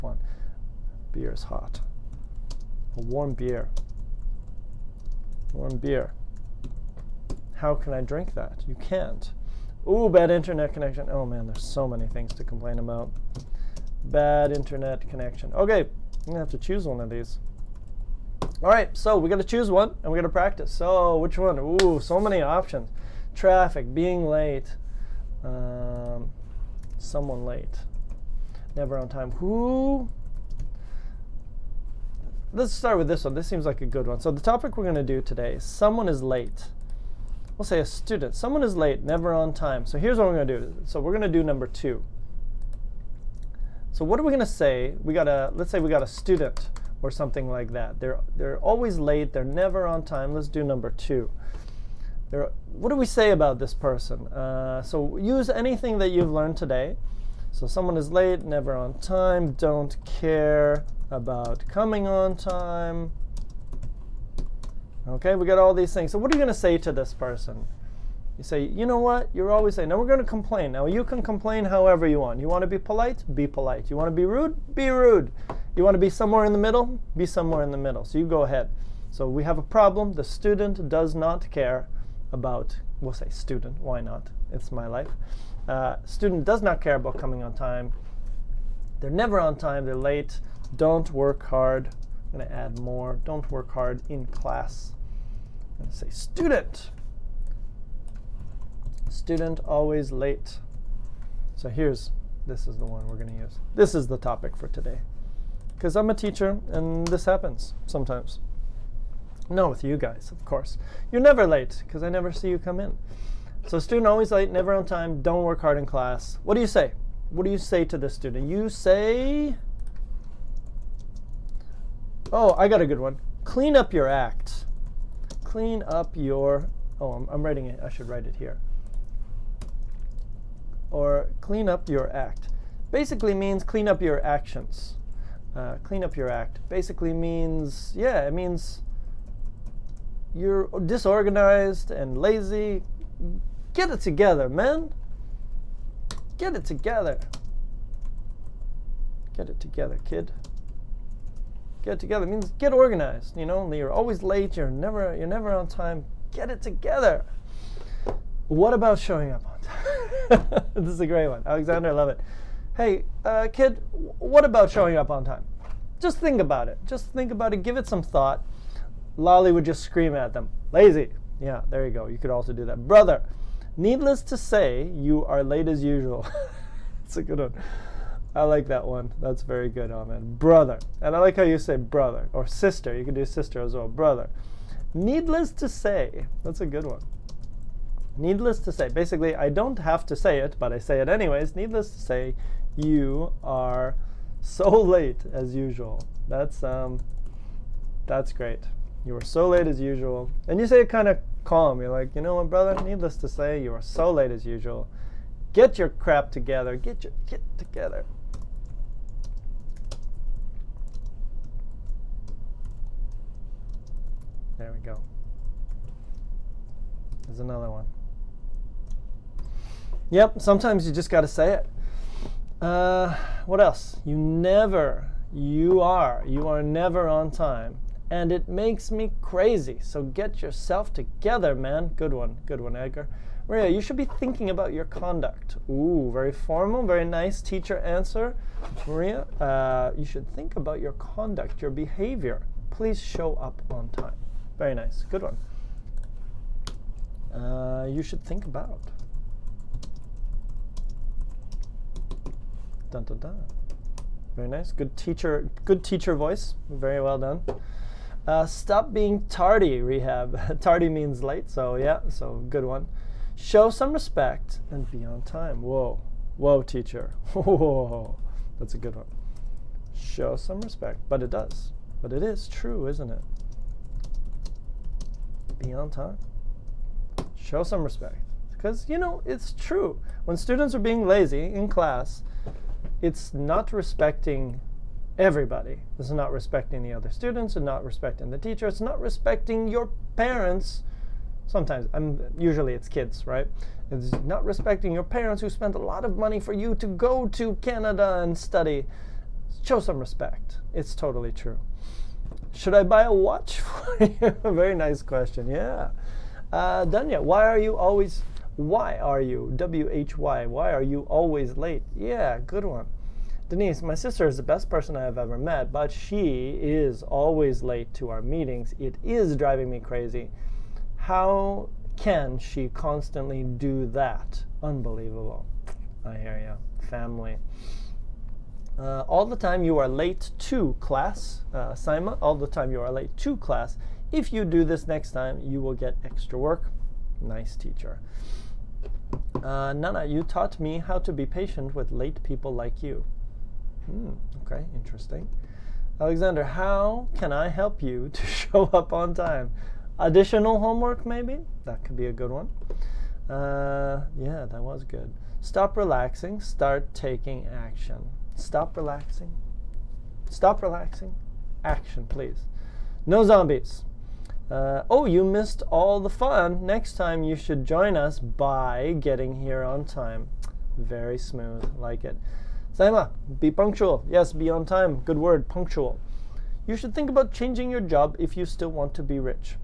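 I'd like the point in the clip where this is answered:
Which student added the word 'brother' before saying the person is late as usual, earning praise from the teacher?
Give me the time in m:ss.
2:59.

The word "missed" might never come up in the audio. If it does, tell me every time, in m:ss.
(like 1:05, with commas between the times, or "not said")
6:05.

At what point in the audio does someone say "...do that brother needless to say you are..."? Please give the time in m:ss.
2:52.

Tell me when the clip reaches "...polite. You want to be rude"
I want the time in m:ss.
1:13.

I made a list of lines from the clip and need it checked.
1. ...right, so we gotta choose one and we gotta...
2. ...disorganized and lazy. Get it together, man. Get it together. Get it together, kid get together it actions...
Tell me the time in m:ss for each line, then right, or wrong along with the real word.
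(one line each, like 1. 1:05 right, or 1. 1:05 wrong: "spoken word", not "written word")
1. 0:18 right
2. 2:20 wrong: "means", not "actions".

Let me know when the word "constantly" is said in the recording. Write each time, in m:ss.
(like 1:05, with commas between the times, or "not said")
5:22.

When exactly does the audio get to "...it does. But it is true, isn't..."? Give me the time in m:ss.
4:31.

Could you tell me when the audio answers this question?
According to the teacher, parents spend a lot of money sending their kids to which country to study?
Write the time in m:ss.
4:57.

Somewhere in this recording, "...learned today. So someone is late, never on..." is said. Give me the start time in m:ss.
0:56.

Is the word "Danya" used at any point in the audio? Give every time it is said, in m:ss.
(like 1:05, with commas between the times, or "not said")
5:06.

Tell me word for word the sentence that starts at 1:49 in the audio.
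No, with you guys, of course.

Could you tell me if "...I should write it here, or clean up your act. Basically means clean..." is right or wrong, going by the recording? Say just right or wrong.
right.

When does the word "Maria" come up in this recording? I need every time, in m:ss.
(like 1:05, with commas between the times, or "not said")
3:53, 3:58.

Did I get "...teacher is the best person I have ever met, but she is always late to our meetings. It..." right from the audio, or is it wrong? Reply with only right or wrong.
wrong.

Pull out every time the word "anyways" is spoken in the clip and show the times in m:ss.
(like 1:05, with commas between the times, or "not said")
3:11.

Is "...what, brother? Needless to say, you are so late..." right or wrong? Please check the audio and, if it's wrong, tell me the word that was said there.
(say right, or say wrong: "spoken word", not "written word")
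right.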